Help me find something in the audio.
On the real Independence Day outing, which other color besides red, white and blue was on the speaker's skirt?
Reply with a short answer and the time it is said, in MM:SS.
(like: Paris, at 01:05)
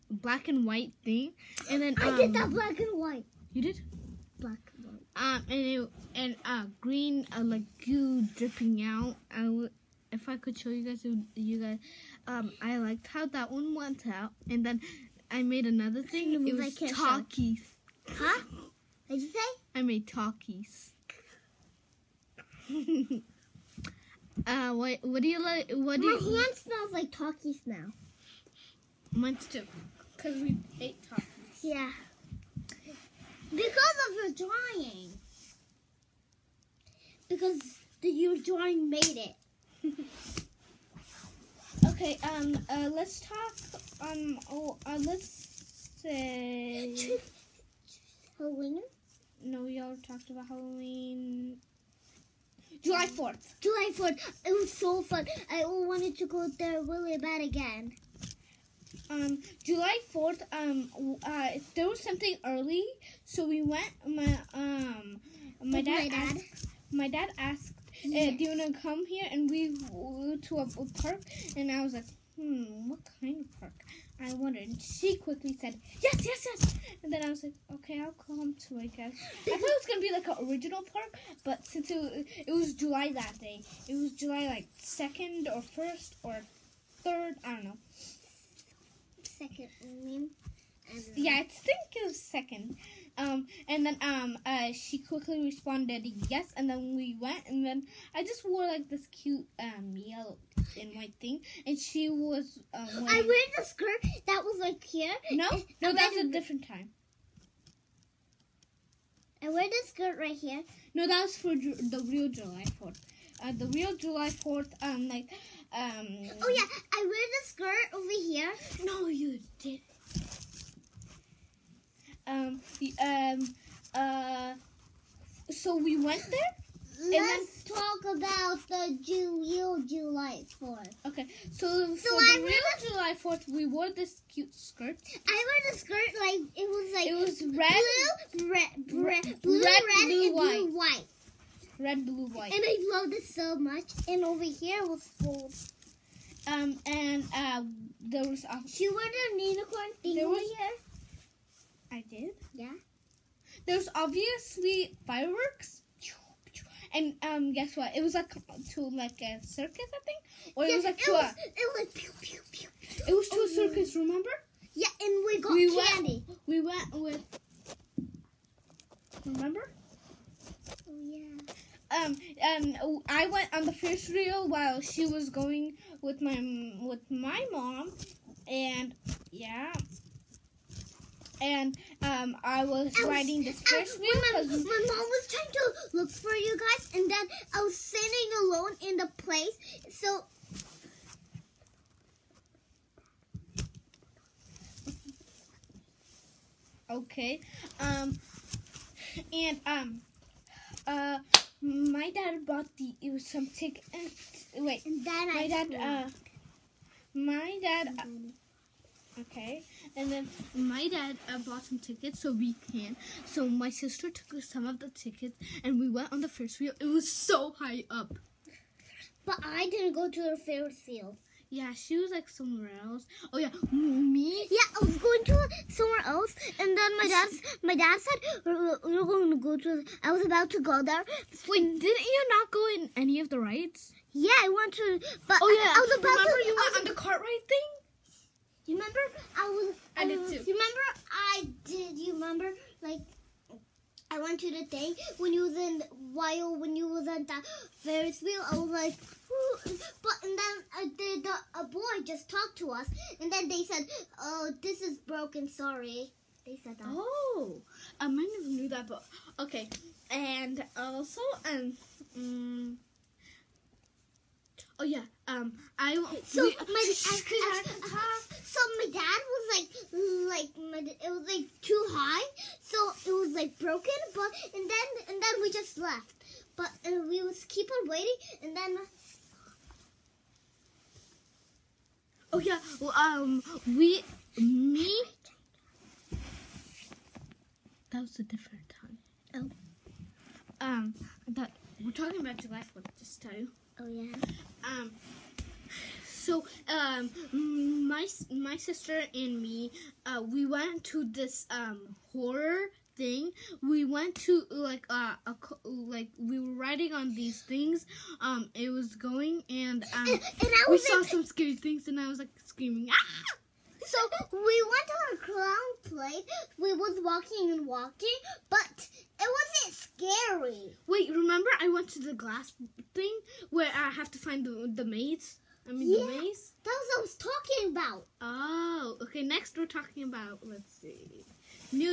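Gold, at 02:24.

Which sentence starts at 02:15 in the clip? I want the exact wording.
I wore the skirt like, it was like...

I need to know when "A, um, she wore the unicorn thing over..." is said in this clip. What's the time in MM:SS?
02:28.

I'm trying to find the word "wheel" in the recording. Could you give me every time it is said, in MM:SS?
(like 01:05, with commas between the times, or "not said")
03:36, 04:08.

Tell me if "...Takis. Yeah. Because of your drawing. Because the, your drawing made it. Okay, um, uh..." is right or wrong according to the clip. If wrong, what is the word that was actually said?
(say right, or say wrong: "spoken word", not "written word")
right.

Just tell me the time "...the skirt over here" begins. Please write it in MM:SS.
01:57.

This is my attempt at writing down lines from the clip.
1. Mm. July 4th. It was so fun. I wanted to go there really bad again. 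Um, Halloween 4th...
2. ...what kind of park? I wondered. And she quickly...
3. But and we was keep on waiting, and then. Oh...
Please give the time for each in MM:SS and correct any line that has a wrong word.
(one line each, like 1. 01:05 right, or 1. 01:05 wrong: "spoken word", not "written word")
1. 00:53 wrong: "July", not "Halloween"
2. 01:12 right
3. 04:36 right.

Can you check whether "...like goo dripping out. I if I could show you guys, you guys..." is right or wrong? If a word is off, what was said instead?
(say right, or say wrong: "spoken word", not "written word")
right.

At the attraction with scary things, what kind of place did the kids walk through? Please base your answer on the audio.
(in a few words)
Clown place.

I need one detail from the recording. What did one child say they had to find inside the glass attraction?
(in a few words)
The maze.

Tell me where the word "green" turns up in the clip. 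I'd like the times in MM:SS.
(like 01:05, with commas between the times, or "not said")
00:06.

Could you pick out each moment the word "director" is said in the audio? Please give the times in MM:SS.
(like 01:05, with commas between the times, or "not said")
not said.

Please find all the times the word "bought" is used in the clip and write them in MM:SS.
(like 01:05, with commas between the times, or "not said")
03:22, 03:31.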